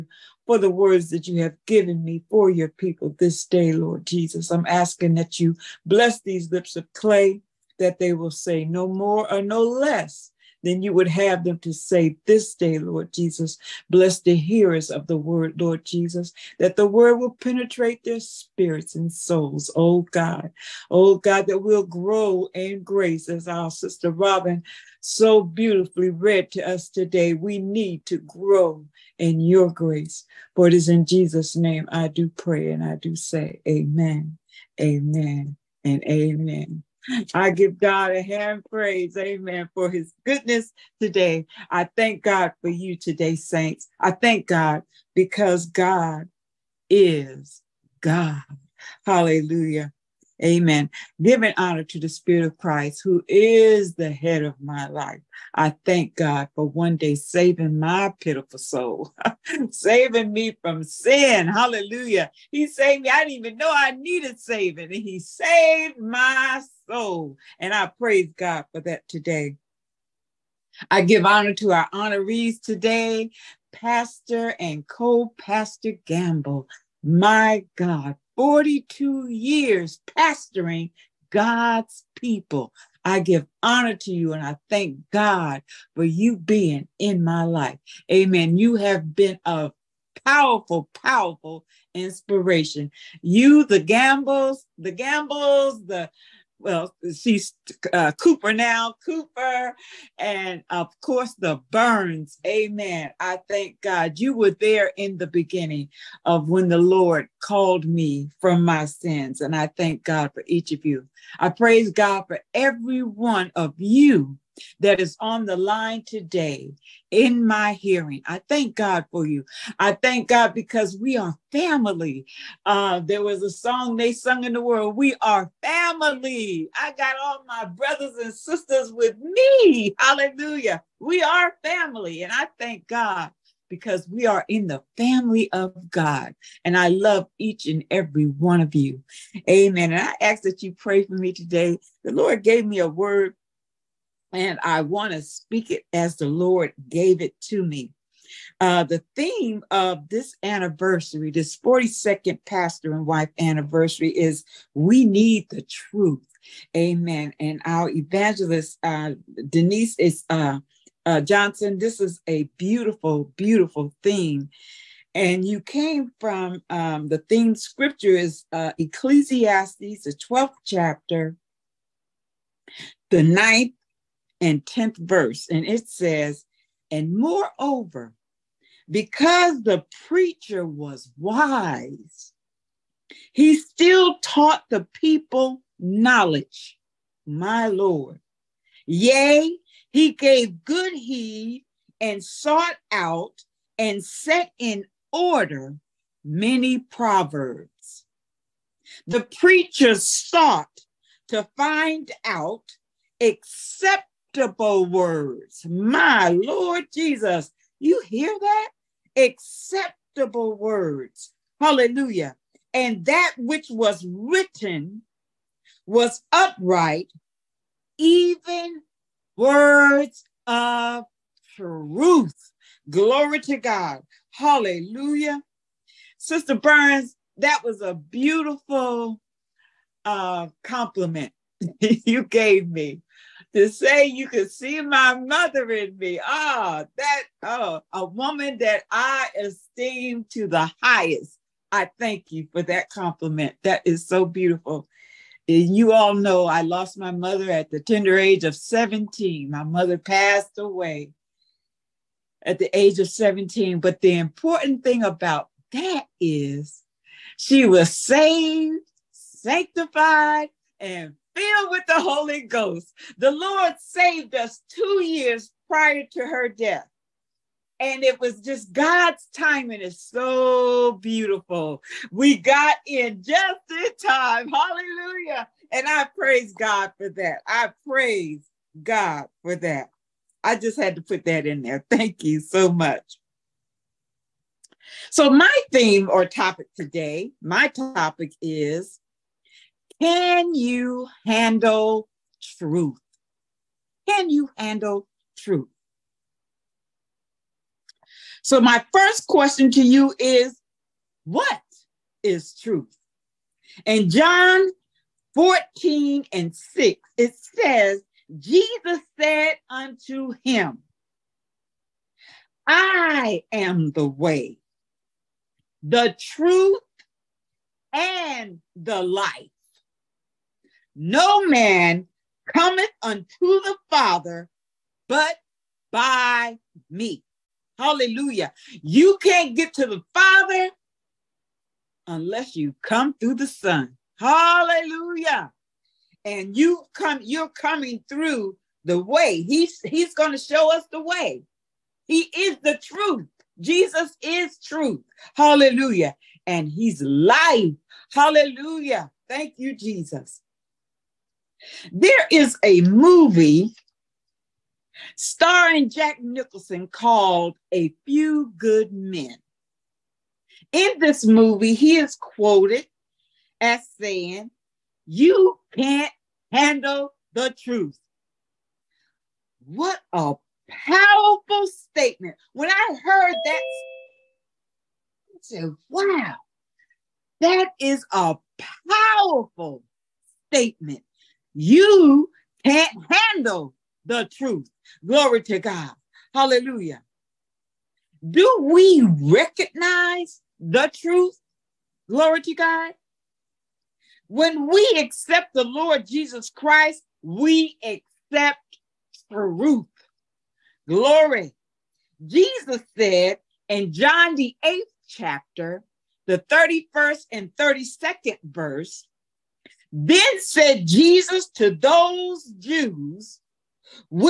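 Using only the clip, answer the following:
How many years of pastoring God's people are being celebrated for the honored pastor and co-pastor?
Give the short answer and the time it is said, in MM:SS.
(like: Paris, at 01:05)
42, at 01:18.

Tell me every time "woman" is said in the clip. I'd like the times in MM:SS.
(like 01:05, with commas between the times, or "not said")
03:58.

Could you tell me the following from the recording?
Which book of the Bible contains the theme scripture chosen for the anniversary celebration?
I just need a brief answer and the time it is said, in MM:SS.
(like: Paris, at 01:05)
Ecclesiastes, at 02:48.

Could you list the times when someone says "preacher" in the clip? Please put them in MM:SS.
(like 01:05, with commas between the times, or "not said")
03:00, 03:19.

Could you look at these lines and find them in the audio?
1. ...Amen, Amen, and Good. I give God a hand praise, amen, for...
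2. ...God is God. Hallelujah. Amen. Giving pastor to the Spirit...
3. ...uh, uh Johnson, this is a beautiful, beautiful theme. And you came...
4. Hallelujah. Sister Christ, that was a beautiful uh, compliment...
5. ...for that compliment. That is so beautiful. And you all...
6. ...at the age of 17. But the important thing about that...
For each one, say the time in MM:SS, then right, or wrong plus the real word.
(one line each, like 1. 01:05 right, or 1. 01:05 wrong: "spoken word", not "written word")
1. 00:33 wrong: "Amen", not "Good"
2. 00:45 wrong: "honor", not "pastor"
3. 02:40 right
4. 03:44 wrong: "Burns", not "Christ"
5. 04:02 right
6. 04:12 right.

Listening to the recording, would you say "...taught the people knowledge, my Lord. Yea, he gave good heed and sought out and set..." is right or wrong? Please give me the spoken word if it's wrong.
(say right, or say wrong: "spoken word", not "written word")
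right.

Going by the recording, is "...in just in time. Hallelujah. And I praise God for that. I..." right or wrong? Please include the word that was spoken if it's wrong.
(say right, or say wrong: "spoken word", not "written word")
right.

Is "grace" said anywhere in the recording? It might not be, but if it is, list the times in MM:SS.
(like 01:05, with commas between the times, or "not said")
00:22, 00:29.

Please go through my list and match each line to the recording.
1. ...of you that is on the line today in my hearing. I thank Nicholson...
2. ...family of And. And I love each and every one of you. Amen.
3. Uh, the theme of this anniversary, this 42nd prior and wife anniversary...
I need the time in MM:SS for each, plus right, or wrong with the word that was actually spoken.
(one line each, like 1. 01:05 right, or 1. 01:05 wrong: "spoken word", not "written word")
1. 01:53 wrong: "God", not "Nicholson"
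2. 02:14 wrong: "God", not "And"
3. 02:28 wrong: "pastor", not "prior".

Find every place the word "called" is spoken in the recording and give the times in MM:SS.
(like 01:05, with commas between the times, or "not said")
01:47, 05:56.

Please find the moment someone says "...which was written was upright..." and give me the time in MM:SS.
03:33.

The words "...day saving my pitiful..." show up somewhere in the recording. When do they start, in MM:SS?
00:56.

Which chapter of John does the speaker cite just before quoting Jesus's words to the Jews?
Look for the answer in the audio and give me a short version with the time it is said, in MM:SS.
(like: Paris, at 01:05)
8th chapter, at 06:44.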